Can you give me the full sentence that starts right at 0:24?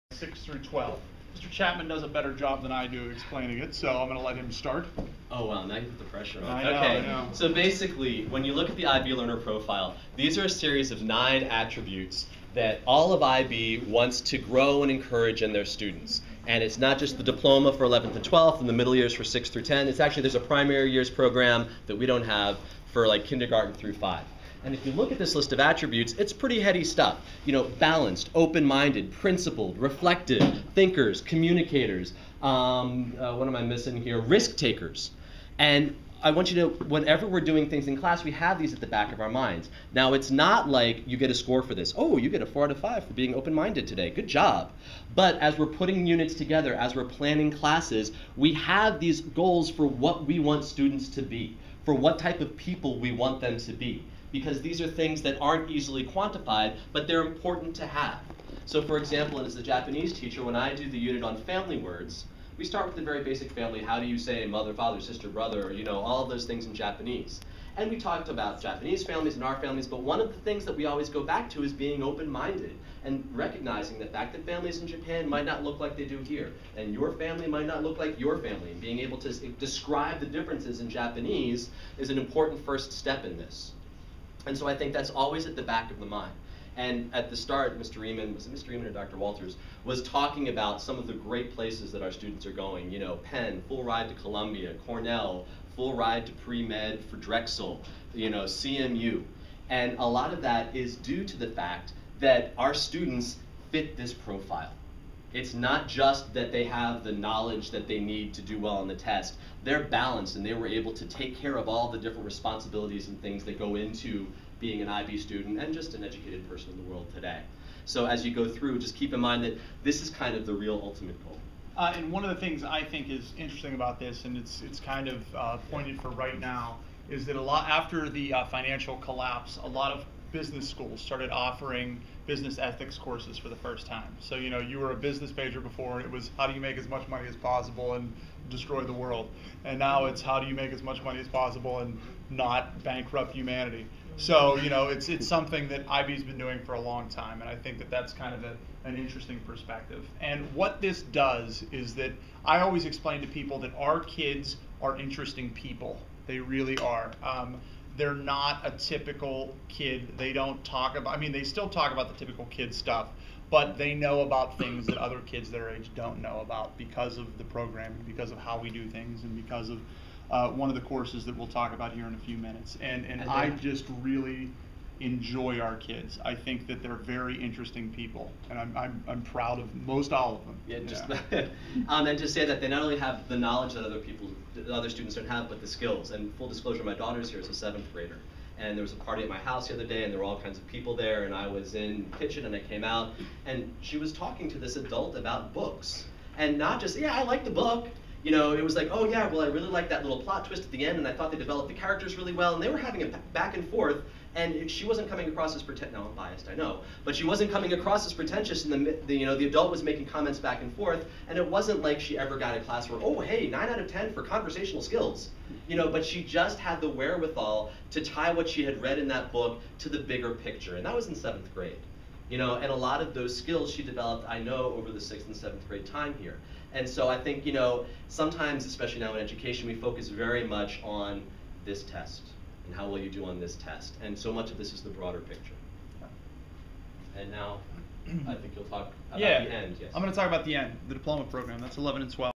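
And if you look at this list of attributes, it's pretty heady stuff.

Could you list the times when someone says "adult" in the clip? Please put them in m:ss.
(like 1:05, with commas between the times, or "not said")
3:14, 3:29.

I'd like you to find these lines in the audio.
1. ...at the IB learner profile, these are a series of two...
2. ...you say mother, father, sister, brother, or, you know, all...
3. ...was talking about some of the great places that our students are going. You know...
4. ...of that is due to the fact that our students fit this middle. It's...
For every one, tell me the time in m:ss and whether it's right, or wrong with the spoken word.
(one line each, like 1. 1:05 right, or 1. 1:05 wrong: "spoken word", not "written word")
1. 0:08 wrong: "nine", not "two"
2. 1:04 right
3. 1:29 right
4. 1:40 wrong: "profile", not "middle".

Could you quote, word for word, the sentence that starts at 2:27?
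And I think that that's kind of a, an interesting perspective.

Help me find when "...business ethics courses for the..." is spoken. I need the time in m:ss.
2:12.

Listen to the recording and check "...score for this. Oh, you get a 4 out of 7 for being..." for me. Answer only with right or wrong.
wrong.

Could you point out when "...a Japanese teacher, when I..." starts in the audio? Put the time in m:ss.
0:59.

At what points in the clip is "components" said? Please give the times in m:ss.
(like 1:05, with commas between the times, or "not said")
not said.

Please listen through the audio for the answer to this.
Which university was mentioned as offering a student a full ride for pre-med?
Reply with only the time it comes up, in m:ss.
1:37.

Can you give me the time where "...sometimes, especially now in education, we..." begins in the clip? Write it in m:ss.
3:48.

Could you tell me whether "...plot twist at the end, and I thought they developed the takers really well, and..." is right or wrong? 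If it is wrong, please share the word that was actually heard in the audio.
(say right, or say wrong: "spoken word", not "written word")
wrong: "characters", not "takers".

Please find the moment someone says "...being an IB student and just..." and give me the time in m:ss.
1:54.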